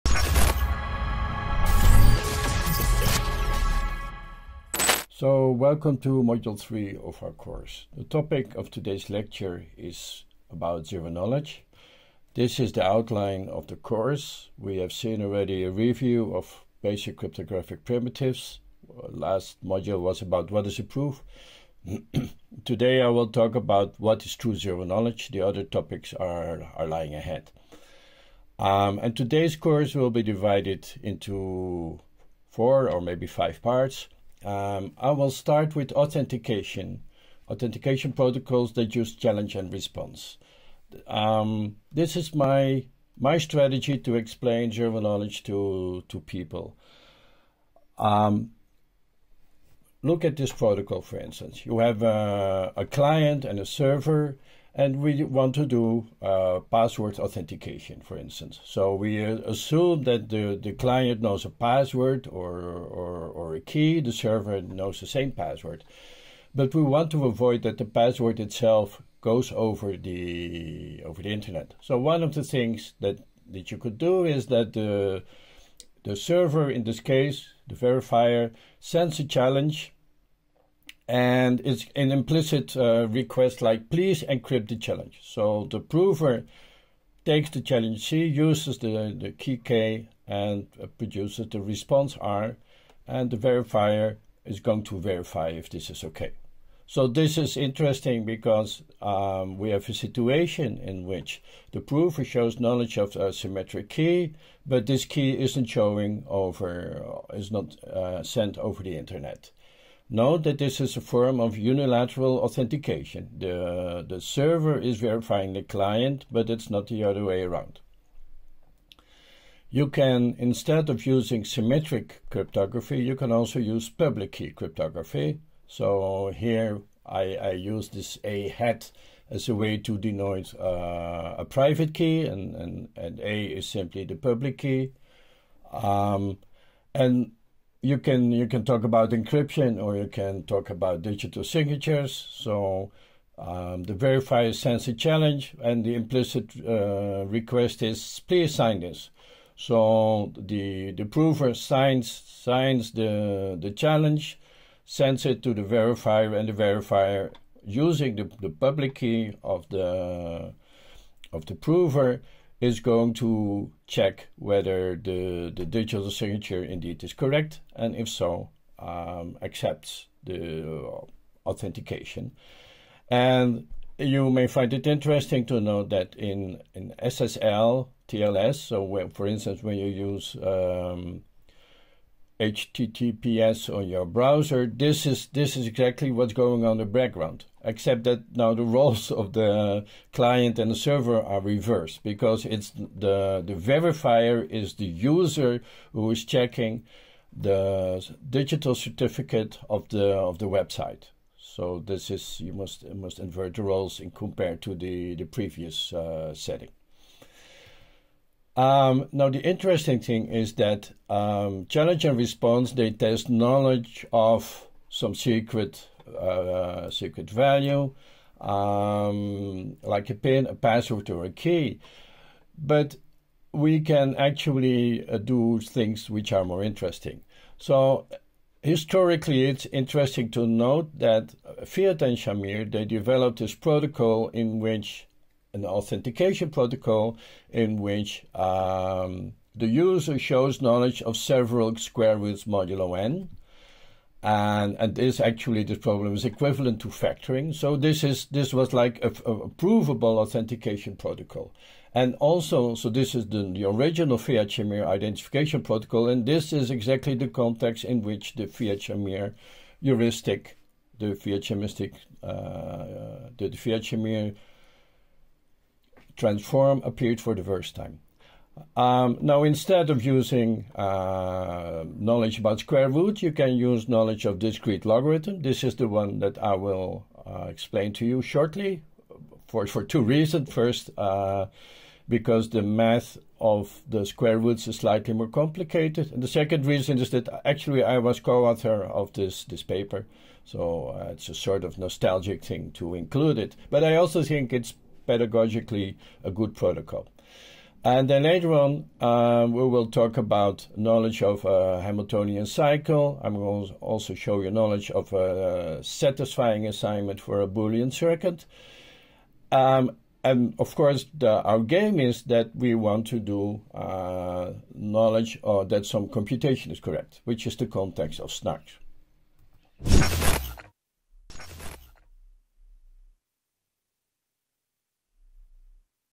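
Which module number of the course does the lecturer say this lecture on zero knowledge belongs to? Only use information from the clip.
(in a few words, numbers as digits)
3.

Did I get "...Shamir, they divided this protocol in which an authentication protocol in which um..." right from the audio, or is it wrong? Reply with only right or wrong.
wrong.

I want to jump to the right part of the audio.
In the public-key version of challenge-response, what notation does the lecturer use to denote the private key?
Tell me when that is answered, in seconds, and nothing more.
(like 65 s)
128 s.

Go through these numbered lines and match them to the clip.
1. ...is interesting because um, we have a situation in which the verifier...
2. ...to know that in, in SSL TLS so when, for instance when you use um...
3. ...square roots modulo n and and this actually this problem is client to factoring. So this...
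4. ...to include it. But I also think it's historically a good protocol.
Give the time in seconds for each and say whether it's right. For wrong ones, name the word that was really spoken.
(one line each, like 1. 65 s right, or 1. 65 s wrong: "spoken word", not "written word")
1. 97 s wrong: "prover", not "verifier"
2. 175 s right
3. 241 s wrong: "equivalent", not "client"
4. 292 s wrong: "pedagogically", not "historically".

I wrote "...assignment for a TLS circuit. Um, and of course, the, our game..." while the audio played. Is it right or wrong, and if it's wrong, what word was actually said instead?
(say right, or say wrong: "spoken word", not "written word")
wrong: "Boolean", not "TLS".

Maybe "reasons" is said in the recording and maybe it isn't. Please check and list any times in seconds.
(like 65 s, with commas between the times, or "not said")
280 s, 286 s.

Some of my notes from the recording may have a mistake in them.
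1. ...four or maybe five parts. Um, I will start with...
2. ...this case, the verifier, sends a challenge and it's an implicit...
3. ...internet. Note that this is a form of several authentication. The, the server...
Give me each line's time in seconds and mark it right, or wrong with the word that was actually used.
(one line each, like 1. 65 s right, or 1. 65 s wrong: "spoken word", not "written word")
1. 32 s right
2. 76 s right
3. 108 s wrong: "unilateral", not "several".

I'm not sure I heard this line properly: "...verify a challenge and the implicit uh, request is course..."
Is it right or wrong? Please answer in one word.
wrong.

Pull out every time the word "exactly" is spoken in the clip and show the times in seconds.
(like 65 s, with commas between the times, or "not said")
185 s, 256 s.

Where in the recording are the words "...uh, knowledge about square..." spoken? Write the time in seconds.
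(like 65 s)
270 s.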